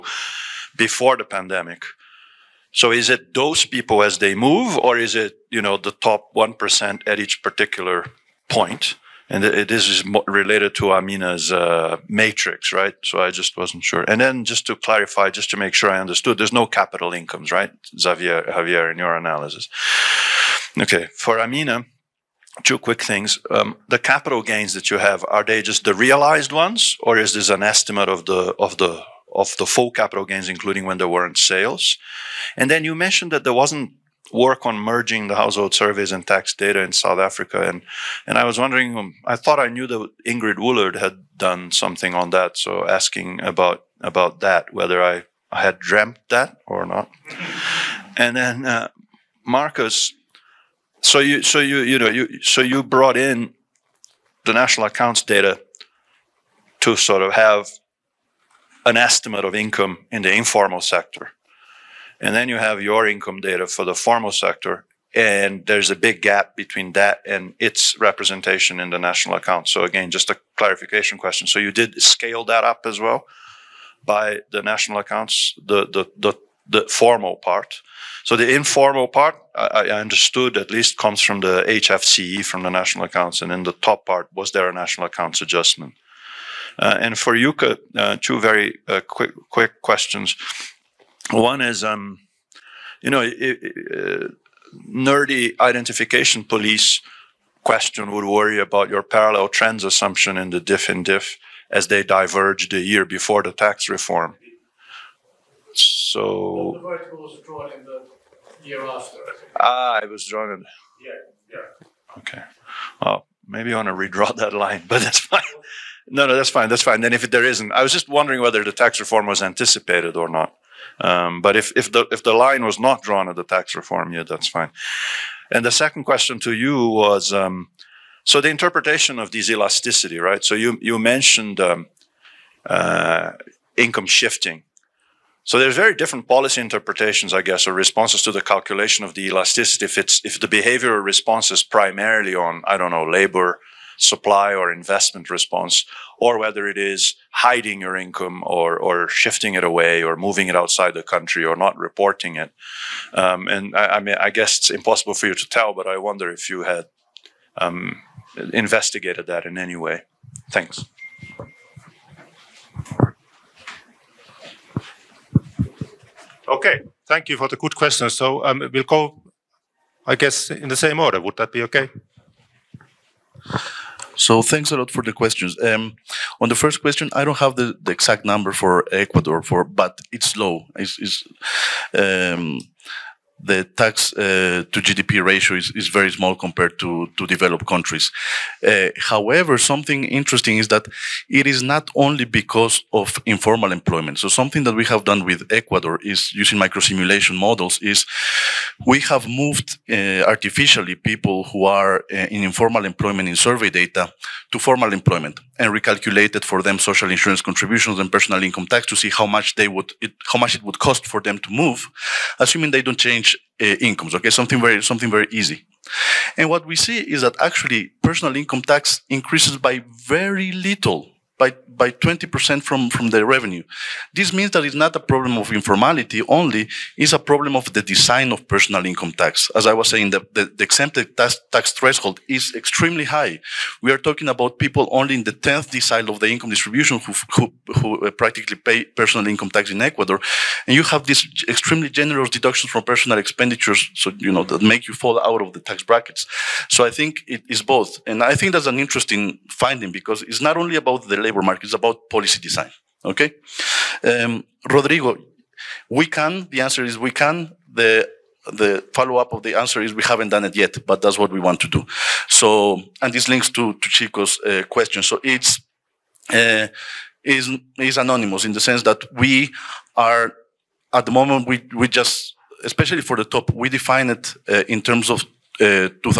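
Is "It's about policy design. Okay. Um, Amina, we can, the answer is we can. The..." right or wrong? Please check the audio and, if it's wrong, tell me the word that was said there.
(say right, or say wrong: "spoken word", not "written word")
wrong: "Rodrigo", not "Amina".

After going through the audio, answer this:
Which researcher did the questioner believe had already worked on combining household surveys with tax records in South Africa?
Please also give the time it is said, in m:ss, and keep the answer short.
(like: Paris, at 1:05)
Ingrid Woolard, at 0:40.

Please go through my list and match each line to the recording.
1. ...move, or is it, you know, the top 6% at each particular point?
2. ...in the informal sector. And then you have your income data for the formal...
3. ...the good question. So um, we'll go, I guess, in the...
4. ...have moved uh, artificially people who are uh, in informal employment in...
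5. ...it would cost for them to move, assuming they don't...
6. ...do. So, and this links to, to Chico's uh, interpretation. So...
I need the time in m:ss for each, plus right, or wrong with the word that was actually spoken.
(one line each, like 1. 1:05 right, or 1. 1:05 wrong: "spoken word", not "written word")
1. 0:04 wrong: "1", not "6"
2. 1:00 right
3. 2:47 right
4. 3:18 right
5. 3:30 right
6. 4:21 wrong: "question", not "interpretation".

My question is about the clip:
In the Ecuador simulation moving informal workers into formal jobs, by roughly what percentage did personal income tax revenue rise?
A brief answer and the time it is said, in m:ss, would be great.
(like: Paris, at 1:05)
20%, at 3:41.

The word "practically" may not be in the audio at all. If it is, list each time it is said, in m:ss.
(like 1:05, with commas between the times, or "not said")
3:58.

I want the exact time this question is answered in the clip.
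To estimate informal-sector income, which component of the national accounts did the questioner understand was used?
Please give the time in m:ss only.
1:21.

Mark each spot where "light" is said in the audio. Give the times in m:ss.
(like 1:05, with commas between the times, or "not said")
not said.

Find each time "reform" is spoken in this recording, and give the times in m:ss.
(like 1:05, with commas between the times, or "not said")
1:43, 1:58, 2:03.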